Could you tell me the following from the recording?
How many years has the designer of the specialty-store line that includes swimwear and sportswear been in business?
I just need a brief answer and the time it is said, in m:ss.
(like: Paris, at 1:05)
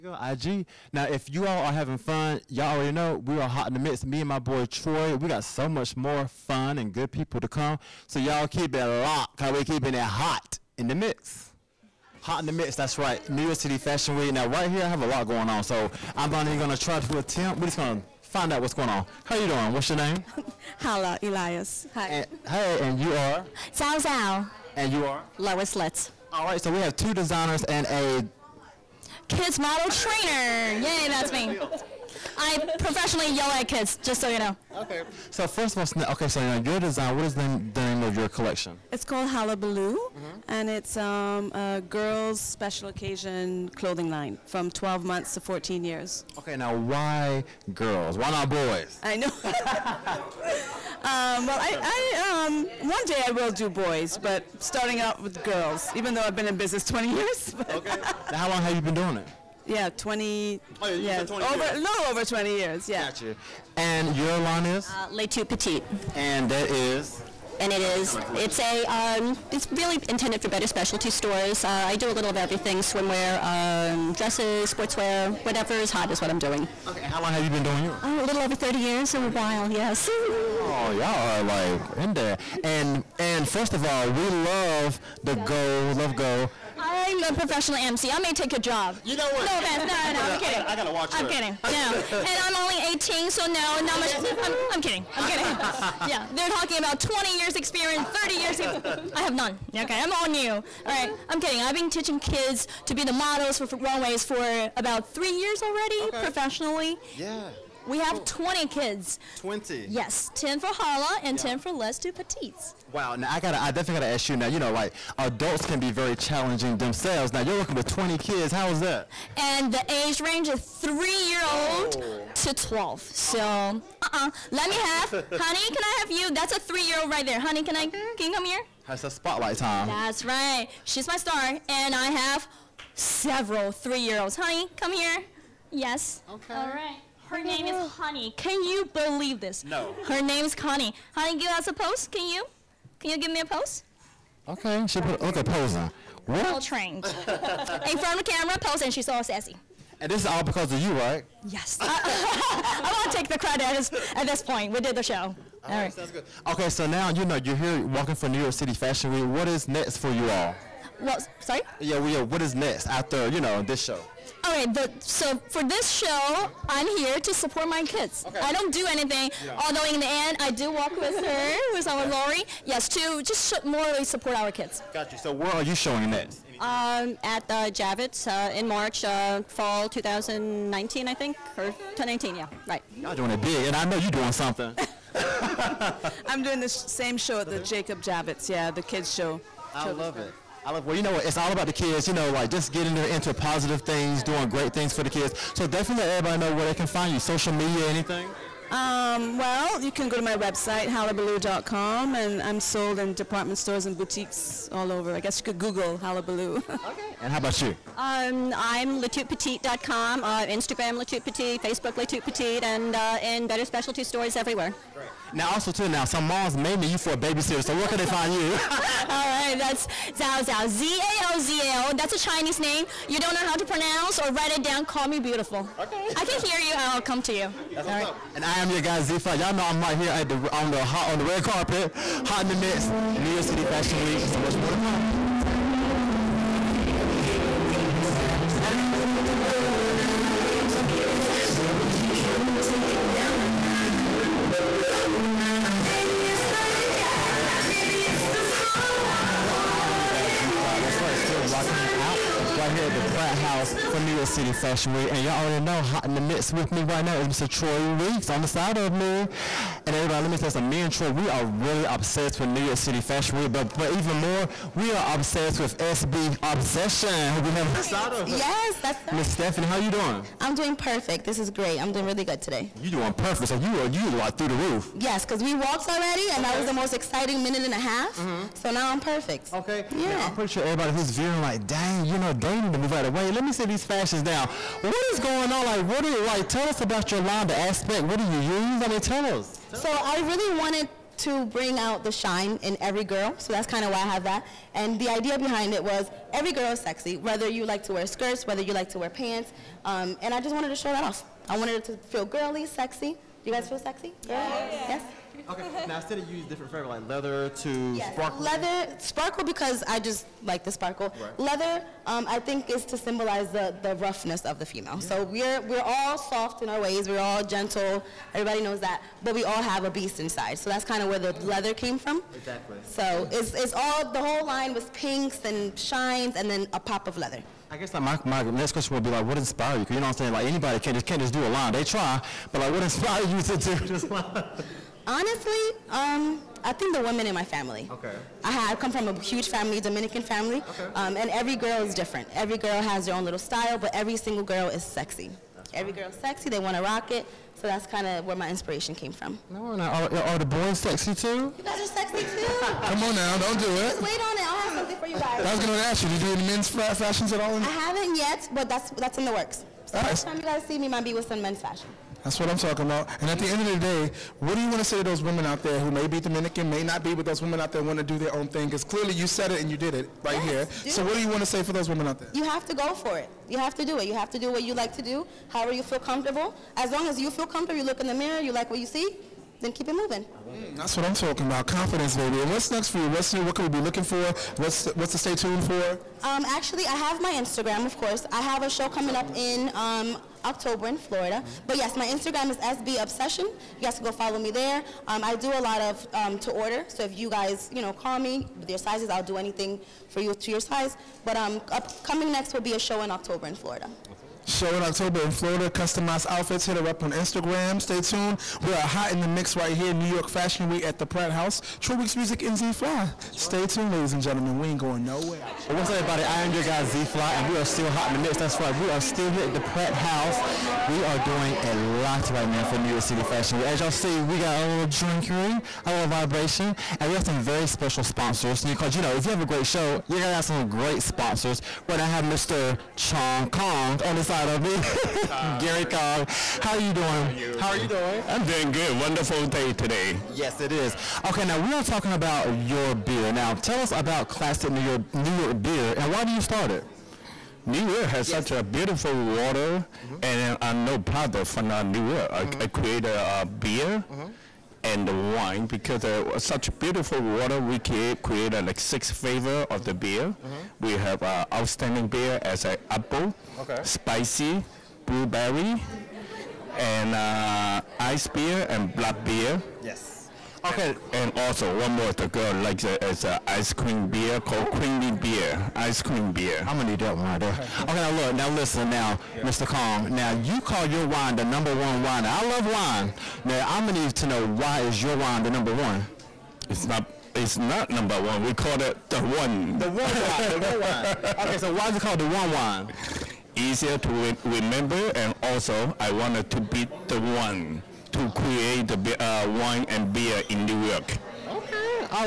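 30, at 1:18.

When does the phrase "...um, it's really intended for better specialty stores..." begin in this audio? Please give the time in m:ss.
1:08.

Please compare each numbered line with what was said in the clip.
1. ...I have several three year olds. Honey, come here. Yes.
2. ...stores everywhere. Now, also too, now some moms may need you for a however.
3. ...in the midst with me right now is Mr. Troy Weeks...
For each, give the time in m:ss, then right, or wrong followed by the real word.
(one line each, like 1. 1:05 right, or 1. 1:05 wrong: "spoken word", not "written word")
1. 2:11 right
2. 3:34 wrong: "babysitter", not "however"
3. 4:16 right.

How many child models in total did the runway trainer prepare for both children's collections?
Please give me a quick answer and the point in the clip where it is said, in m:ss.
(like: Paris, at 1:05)
20, at 1:47.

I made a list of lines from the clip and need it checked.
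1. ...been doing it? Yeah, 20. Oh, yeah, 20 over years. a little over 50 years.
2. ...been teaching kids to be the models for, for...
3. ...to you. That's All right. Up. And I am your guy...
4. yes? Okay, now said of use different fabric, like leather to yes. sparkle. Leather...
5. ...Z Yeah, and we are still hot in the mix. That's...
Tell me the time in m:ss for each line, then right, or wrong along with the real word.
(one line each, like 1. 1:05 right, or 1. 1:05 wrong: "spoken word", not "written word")
1. 0:58 wrong: "20", not "50"
2. 1:41 right
3. 3:47 right
4. 5:04 right
5. 6:56 wrong: "Fly", not "Yeah".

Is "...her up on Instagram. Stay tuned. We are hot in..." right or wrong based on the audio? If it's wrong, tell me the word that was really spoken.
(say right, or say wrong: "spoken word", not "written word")
right.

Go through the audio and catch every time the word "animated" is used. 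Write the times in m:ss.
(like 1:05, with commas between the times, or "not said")
not said.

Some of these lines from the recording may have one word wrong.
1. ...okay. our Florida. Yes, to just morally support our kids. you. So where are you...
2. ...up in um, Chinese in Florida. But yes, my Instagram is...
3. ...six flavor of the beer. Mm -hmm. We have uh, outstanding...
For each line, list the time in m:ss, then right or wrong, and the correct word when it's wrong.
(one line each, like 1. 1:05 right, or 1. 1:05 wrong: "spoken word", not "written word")
1. 2:51 wrong: "Lori", not "Florida"
2. 6:29 wrong: "October", not "Chinese"
3. 7:38 right.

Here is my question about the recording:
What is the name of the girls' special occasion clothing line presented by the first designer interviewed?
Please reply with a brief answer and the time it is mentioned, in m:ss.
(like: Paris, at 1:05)
Hullabaloo, at 0:38.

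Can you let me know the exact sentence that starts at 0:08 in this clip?
So y'all keep it locked, cause we keeping it hot in the mix.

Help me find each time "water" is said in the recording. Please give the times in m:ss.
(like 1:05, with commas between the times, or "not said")
7:29, 7:37.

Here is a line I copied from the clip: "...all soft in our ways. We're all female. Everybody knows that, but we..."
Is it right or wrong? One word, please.
wrong.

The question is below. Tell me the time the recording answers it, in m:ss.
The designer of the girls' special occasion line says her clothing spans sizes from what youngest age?
0:44.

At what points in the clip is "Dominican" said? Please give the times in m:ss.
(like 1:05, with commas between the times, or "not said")
5:39, 6:06.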